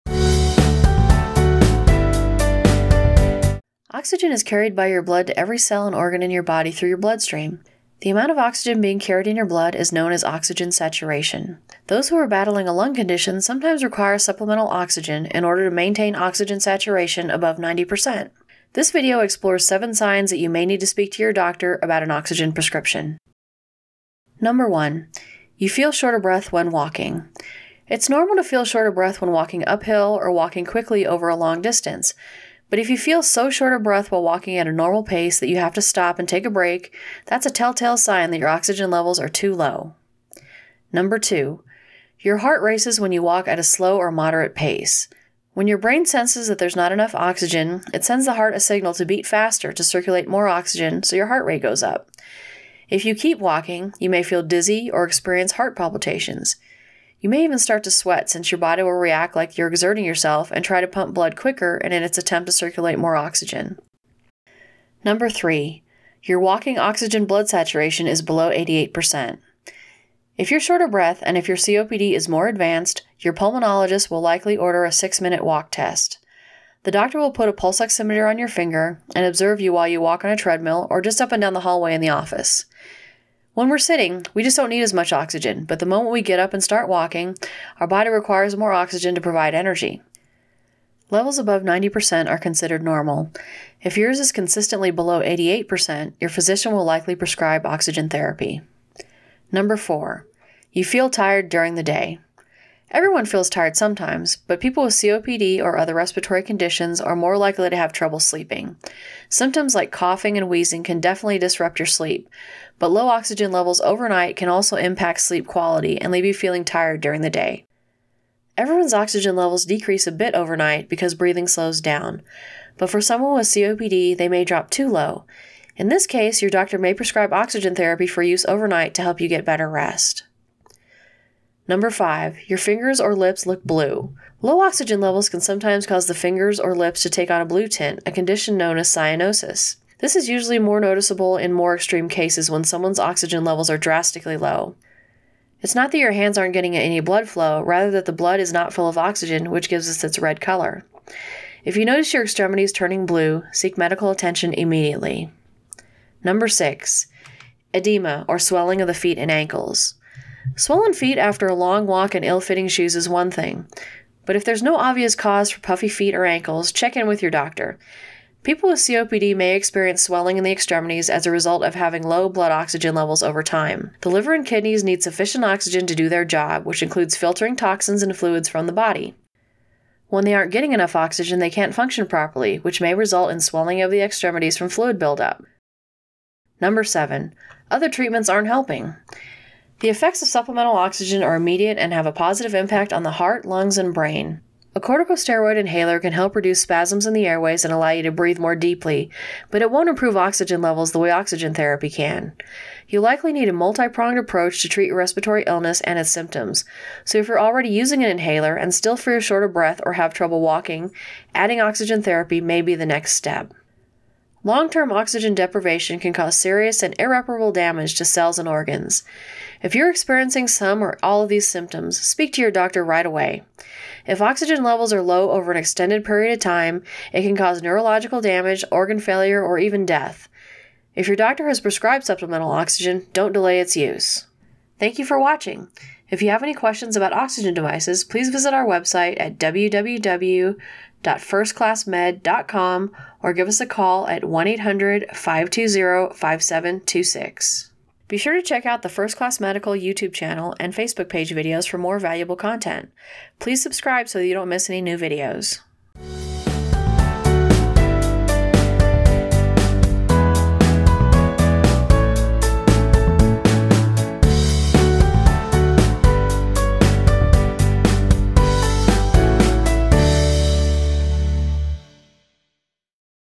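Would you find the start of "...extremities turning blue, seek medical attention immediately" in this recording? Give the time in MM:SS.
02:32.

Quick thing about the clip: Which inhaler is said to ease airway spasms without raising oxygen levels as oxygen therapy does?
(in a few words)
corticosteroid inhaler.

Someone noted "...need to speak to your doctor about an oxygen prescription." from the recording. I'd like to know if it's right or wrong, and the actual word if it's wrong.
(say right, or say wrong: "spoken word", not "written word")
right.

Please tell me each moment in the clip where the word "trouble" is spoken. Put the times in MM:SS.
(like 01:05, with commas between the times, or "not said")
01:47, 03:30.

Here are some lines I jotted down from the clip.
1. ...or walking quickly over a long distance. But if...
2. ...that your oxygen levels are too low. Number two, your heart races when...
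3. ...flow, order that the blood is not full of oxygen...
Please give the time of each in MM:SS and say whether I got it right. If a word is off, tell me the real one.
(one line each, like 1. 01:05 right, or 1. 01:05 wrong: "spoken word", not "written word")
1. 00:30 right
2. 00:38 right
3. 02:27 wrong: "rather", not "order".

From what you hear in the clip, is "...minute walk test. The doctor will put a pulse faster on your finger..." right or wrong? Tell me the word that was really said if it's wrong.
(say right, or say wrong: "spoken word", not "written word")
wrong: "oximeter", not "faster".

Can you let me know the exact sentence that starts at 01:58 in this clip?
Everyone's oxygen levels decrease a bit overnight because breathing slows down, but for someone with COPD, they may drop too low.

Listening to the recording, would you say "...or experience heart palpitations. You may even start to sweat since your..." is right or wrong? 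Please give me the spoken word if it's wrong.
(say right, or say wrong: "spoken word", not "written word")
right.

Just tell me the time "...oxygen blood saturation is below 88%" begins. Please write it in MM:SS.
01:06.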